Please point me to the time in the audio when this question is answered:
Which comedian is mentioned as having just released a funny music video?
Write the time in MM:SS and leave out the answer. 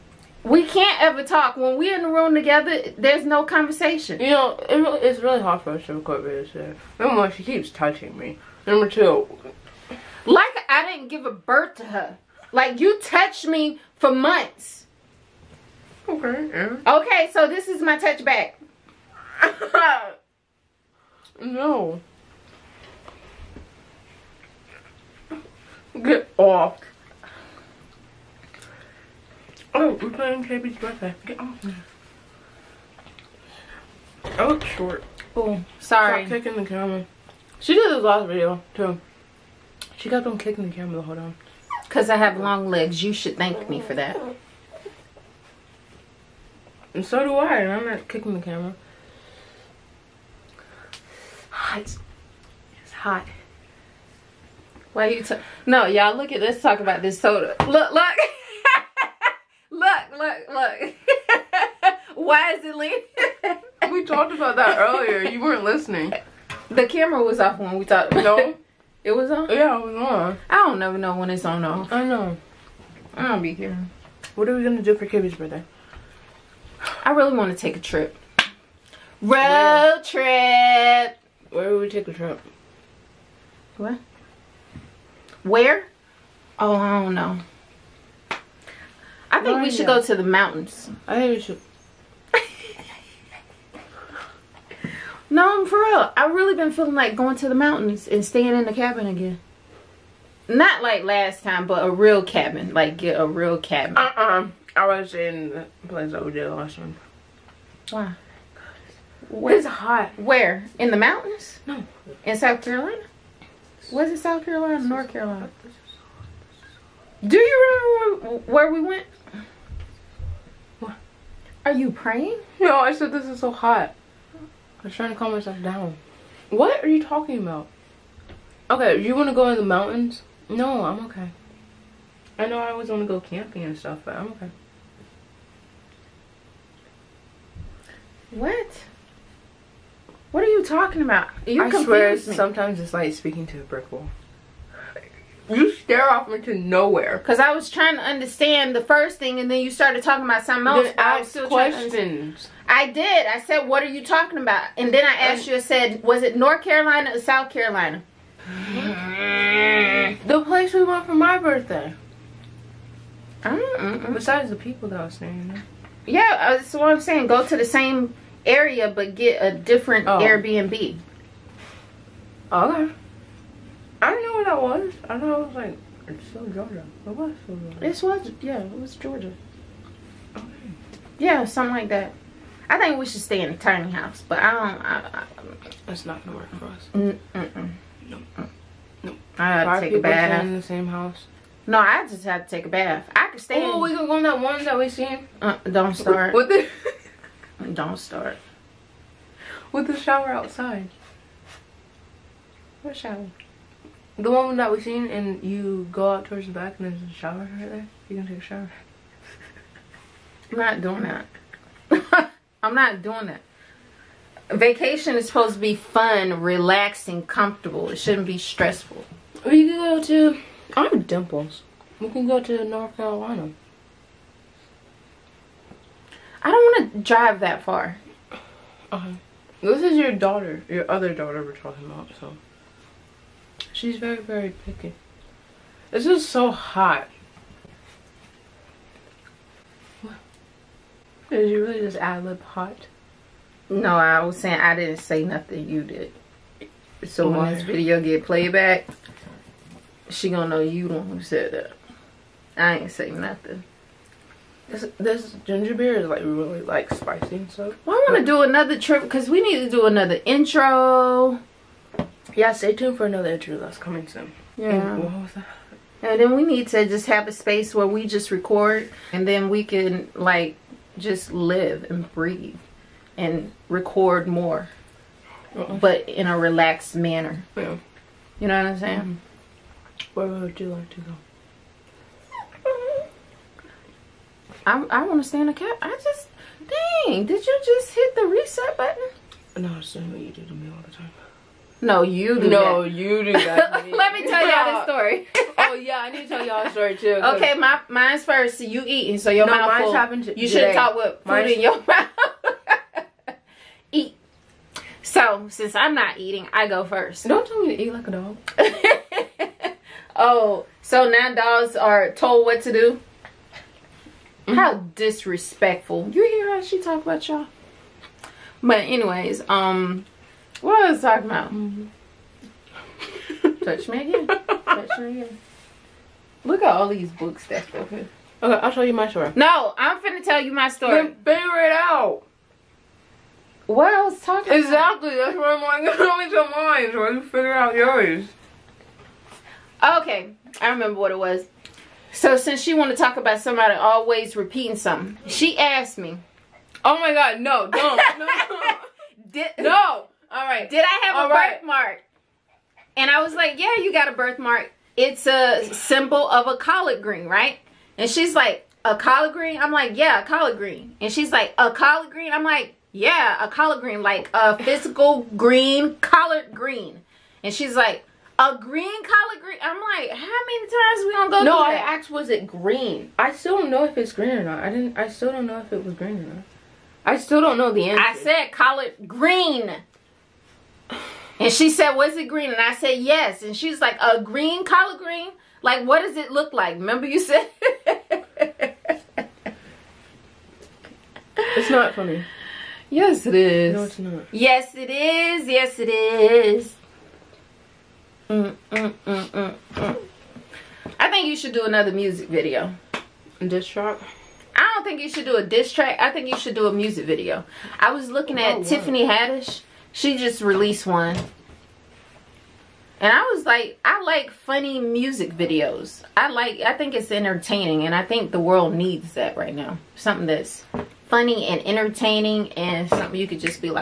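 06:48.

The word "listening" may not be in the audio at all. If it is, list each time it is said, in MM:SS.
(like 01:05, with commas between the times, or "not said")
01:05.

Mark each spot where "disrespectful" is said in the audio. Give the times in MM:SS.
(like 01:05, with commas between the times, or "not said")
05:14.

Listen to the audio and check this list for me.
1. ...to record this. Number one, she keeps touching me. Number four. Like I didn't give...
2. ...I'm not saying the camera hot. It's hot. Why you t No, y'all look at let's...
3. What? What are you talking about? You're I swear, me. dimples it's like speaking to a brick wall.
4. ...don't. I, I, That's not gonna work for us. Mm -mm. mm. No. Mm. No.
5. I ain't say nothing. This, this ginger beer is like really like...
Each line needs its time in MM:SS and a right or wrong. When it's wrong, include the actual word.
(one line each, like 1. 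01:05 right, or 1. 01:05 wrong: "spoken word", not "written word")
1. 00:05 wrong: "two", not "four"
2. 00:47 wrong: "kicking", not "saying"
3. 02:18 wrong: "sometimes", not "dimples"
4. 03:04 right
5. 04:12 right.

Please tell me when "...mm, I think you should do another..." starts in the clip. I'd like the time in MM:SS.
06:39.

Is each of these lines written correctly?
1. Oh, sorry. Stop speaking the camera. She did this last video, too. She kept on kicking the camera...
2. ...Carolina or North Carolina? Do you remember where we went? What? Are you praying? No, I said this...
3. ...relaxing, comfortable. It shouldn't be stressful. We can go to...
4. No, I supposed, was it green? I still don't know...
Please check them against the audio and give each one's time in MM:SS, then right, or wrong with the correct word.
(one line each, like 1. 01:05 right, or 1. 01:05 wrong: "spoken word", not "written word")
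1. 00:35 wrong: "kicking", not "speaking"
2. 01:54 right
3. 03:36 right
4. 06:11 wrong: "asked", not "supposed".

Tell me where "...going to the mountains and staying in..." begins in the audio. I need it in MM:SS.
01:37.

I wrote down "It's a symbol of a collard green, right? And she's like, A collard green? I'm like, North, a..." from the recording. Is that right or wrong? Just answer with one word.
wrong.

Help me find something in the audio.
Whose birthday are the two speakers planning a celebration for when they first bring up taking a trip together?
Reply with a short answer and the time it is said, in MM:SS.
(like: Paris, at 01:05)
KB, at 00:30.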